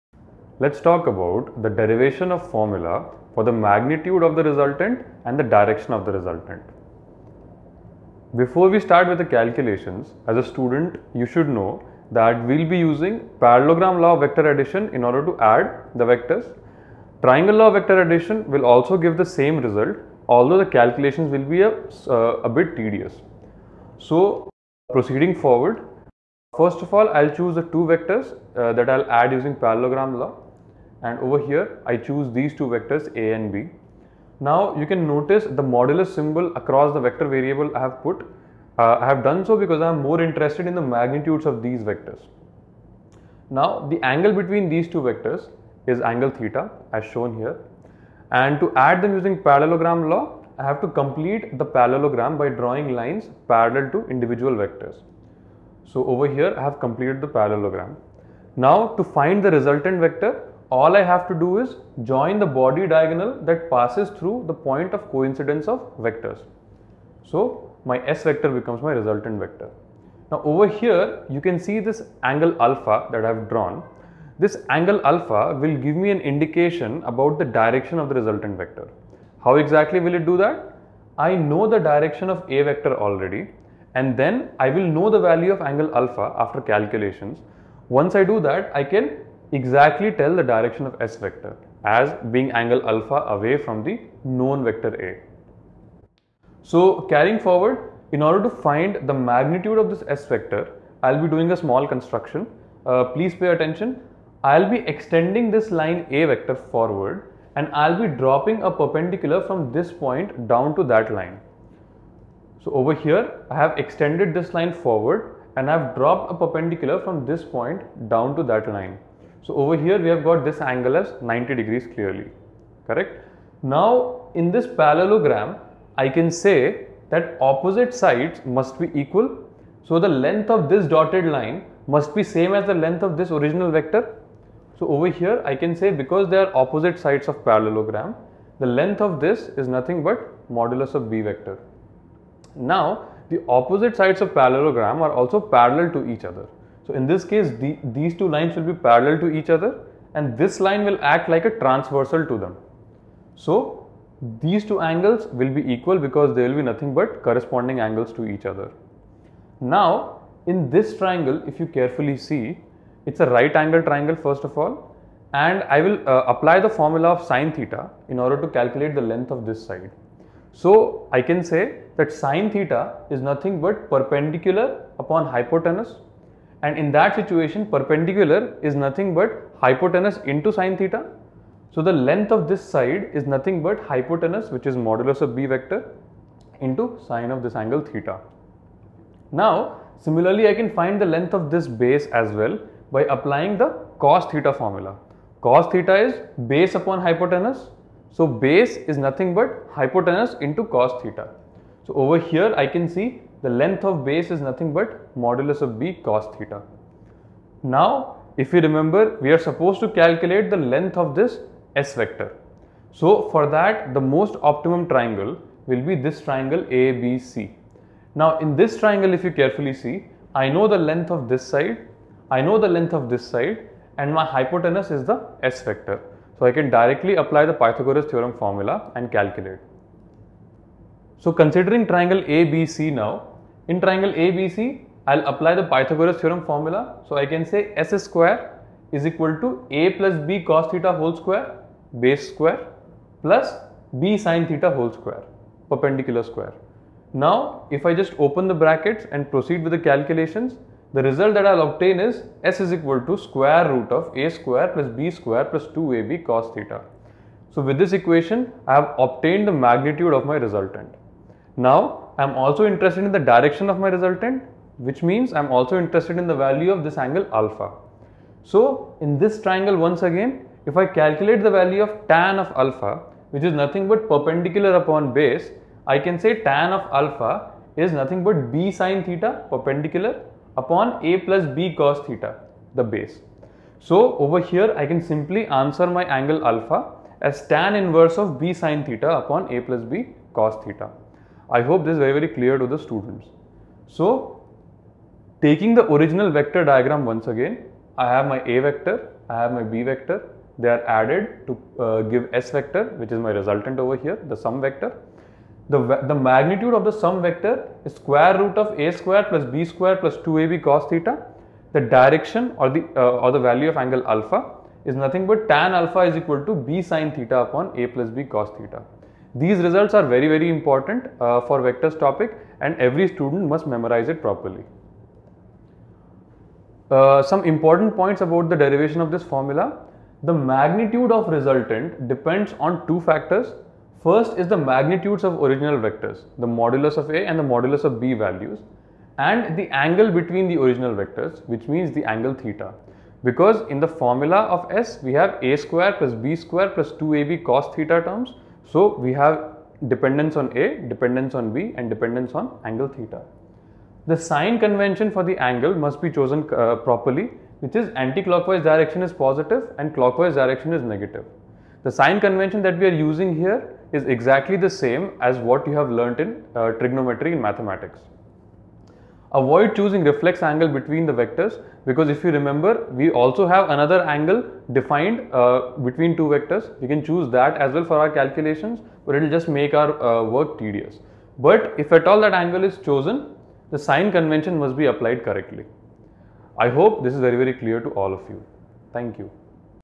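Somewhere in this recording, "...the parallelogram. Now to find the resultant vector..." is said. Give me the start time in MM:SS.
00:57.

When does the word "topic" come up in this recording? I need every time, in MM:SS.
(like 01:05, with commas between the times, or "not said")
05:21.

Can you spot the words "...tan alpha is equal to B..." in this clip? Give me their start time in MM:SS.
05:15.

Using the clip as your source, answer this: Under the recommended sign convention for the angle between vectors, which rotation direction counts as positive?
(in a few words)
Anti-clockwise.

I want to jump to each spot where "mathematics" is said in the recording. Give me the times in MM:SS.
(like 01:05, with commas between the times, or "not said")
06:07.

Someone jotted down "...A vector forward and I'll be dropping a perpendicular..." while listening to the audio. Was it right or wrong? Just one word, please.
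right.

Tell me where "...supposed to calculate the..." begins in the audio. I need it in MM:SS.
03:29.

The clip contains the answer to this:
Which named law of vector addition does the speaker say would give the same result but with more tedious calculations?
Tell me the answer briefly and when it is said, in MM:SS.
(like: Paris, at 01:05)
Triangle law, at 00:17.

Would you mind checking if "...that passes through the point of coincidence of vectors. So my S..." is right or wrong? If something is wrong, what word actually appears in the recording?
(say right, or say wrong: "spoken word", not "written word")
right.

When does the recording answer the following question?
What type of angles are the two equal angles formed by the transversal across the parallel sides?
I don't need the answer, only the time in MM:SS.
02:37.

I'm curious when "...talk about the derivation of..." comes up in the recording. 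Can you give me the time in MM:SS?
00:00.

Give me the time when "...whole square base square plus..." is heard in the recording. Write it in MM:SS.
04:00.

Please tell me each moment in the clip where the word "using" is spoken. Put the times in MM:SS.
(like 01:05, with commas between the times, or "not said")
00:12, 00:29, 00:49, 06:02.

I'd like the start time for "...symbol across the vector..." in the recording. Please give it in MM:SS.
00:36.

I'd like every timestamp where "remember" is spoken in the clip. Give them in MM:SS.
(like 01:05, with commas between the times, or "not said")
03:28, 06:12.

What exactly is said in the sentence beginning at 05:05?
The, the magnitude of the sum vector is square root of A square plus B square plus 2AB cos theta.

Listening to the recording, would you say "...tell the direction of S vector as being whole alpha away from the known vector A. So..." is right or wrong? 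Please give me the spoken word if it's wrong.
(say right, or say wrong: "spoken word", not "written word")
wrong: "angle", not "whole".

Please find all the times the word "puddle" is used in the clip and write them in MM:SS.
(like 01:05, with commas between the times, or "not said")
not said.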